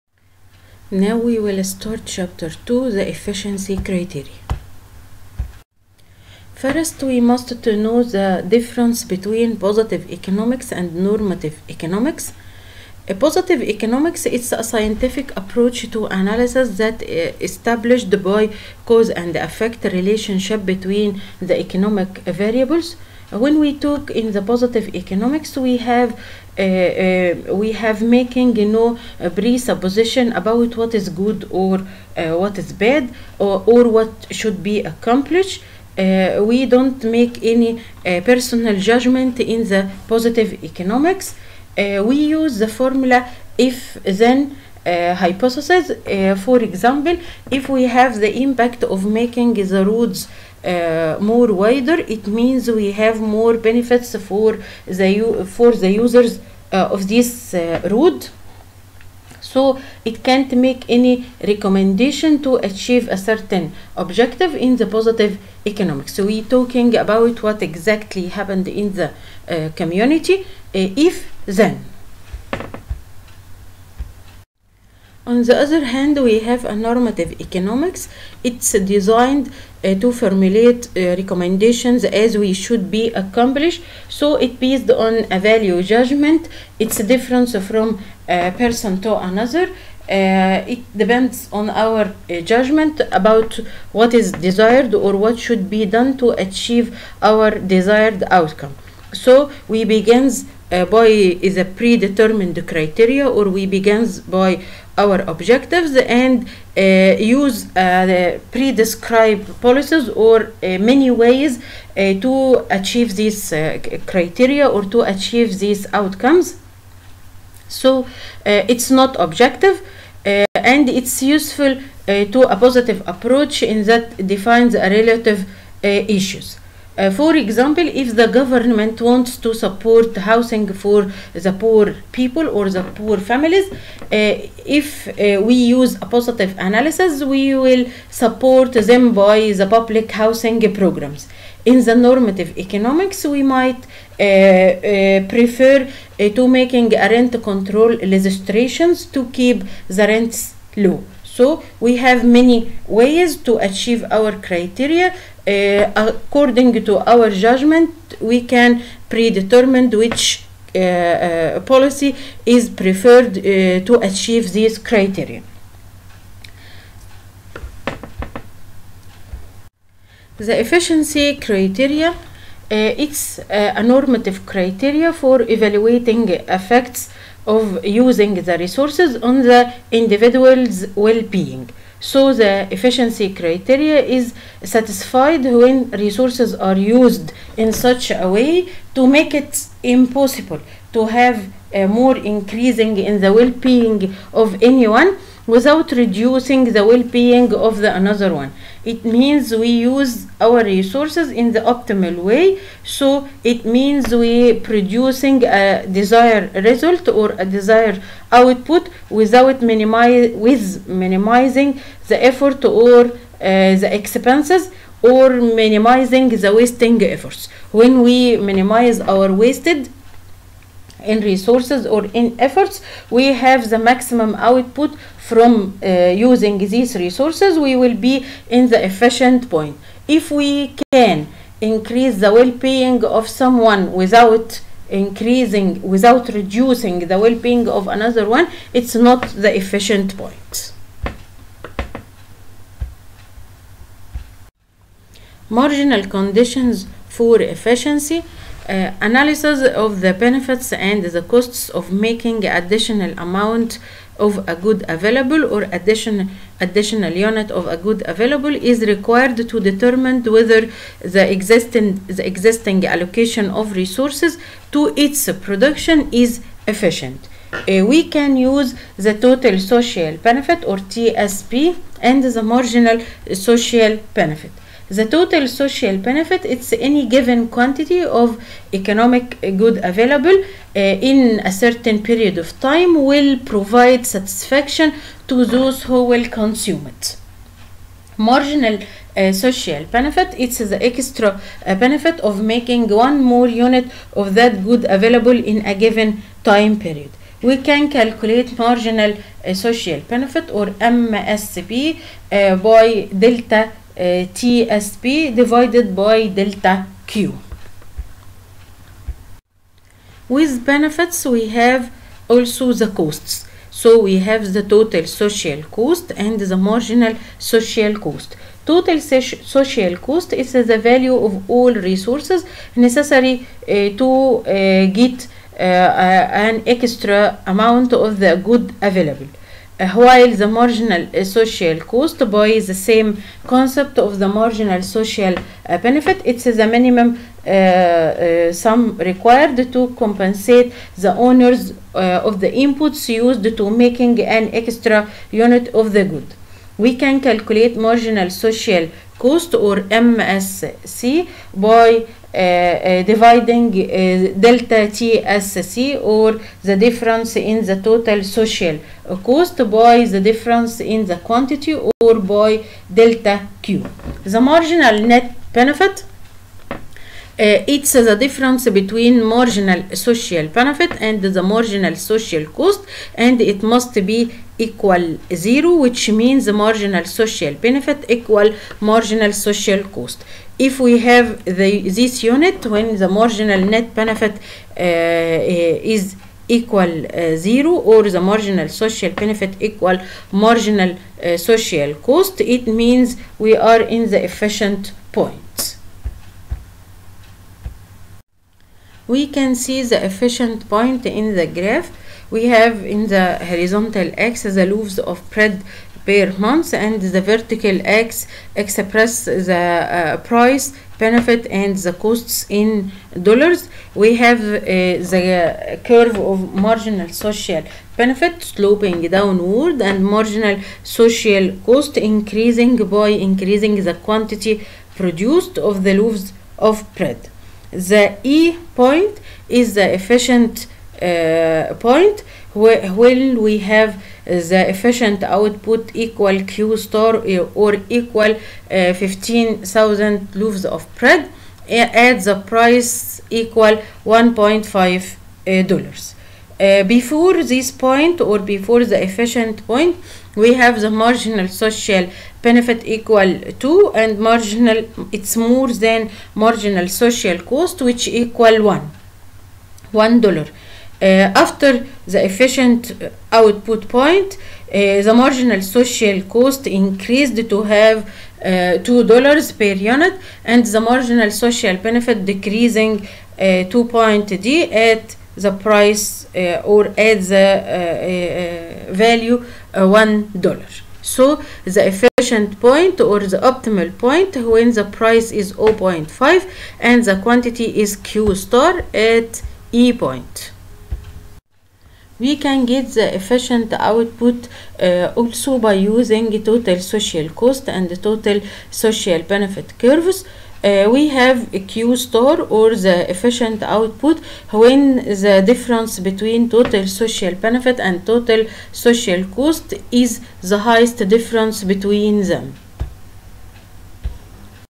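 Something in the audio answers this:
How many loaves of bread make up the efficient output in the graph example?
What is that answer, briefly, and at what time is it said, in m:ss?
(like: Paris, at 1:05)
15,000, at 7:18.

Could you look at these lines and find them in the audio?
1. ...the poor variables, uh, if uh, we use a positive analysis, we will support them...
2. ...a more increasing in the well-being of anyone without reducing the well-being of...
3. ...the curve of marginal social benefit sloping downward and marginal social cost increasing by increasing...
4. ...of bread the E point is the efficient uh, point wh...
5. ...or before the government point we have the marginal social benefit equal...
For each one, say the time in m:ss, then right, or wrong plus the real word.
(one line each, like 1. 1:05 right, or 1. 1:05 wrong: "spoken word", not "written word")
1. 2:12 wrong: "families", not "variables"
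2. 3:11 right
3. 6:55 right
4. 7:06 right
5. 7:28 wrong: "efficient", not "government".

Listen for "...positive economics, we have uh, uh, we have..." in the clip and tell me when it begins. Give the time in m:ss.
0:24.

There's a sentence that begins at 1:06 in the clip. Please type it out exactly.
So we're talking about what exactly happened in the uh, community.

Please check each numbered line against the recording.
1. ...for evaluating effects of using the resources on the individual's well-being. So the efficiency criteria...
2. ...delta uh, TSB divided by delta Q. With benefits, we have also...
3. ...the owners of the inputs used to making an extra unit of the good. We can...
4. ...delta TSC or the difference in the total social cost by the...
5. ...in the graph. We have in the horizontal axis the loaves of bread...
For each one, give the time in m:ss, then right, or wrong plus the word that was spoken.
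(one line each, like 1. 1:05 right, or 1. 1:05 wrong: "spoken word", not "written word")
1. 2:55 right
2. 5:03 right
3. 5:40 right
4. 5:54 right
5. 6:41 right.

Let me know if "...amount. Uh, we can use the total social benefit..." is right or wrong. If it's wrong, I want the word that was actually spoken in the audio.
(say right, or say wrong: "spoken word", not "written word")
wrong: "efficient", not "amount".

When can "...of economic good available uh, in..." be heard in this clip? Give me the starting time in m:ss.
4:38.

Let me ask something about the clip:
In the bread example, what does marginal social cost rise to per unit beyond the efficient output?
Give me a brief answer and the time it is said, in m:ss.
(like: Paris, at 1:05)
2 dollars, at 7:48.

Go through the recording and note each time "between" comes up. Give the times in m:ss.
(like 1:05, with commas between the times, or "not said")
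0:09, 0:20, 6:08, 8:25, 8:31.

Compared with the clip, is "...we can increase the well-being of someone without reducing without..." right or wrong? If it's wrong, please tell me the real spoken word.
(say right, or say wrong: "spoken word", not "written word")
wrong: "increasing", not "reducing".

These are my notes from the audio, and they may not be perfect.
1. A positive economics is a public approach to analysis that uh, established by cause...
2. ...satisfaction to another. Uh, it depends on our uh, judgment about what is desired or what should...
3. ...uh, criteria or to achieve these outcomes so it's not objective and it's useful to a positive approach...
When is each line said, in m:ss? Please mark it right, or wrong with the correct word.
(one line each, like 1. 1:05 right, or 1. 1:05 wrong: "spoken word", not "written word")
1. 0:13 wrong: "scientific", not "public"
2. 1:28 wrong: "person", not "satisfaction"
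3. 1:53 right.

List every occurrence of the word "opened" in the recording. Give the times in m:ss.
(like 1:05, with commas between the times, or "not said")
not said.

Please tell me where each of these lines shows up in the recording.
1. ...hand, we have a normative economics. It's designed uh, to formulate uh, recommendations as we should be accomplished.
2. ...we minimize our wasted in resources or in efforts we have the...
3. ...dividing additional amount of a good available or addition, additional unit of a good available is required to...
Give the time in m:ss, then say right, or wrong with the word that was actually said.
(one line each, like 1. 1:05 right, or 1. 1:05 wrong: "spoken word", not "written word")
1. 1:15 right
2. 3:38 right
3. 4:11 wrong: "making", not "dividing".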